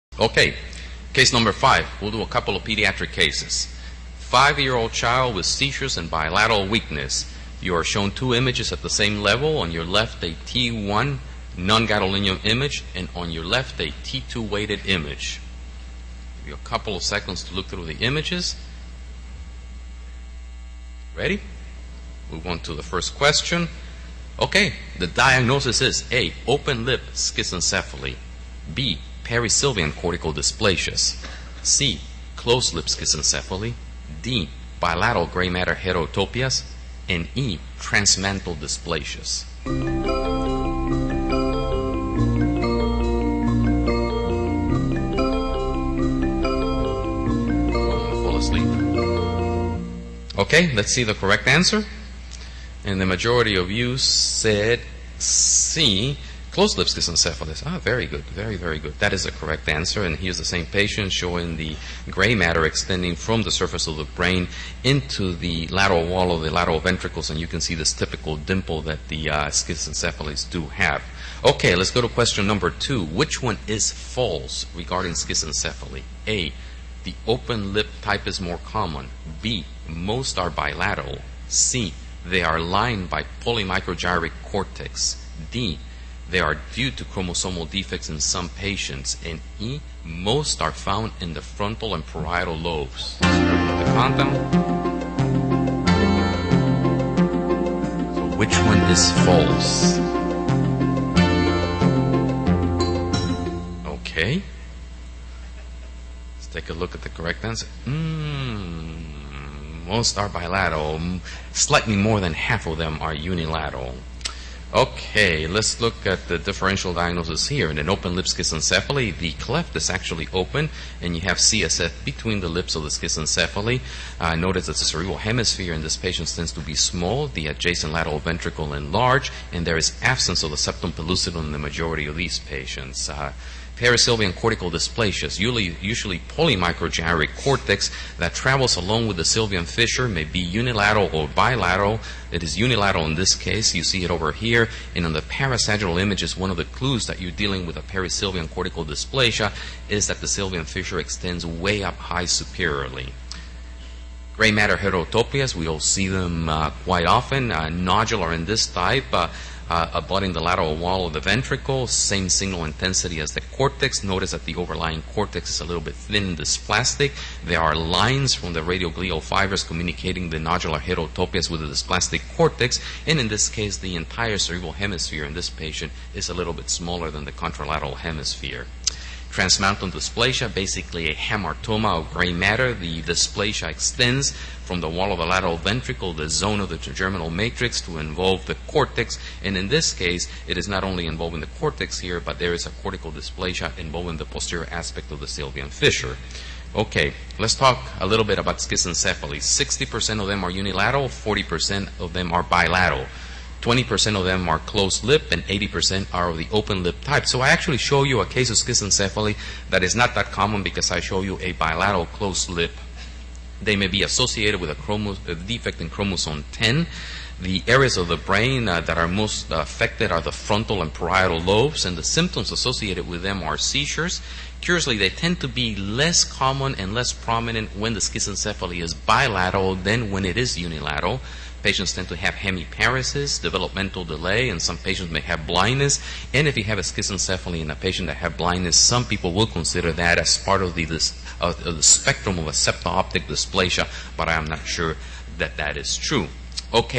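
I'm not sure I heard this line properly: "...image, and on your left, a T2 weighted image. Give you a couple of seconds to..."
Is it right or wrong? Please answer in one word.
right.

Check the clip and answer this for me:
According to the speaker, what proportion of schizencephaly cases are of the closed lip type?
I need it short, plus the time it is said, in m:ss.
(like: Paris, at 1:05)
20%, at 3:23.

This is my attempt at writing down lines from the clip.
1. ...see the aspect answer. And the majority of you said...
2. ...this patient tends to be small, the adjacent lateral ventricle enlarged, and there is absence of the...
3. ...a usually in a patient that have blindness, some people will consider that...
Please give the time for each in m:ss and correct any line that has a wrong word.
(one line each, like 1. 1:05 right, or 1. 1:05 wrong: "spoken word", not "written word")
1. 0:50 wrong: "correct", not "aspect"
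2. 2:05 right
3. 3:56 wrong: "schizencephaly", not "usually".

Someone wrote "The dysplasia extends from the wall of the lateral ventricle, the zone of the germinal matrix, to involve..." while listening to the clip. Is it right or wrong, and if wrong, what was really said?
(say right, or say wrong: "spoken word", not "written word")
right.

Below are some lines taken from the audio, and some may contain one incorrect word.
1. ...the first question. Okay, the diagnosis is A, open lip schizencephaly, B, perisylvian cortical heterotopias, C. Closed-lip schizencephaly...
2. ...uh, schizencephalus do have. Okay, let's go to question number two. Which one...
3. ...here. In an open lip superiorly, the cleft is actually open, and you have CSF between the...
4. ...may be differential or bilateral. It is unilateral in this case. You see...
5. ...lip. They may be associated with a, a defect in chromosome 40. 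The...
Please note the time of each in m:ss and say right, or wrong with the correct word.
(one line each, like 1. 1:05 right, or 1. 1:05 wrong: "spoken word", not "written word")
1. 0:22 wrong: "dysplasias", not "heterotopias"
2. 1:09 right
3. 1:57 wrong: "schizencephaly", not "superiorly"
4. 2:20 wrong: "unilateral", not "differential"
5. 3:32 wrong: "10", not "40".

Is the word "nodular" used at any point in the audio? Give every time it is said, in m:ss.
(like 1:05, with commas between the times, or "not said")
2:37, 2:50.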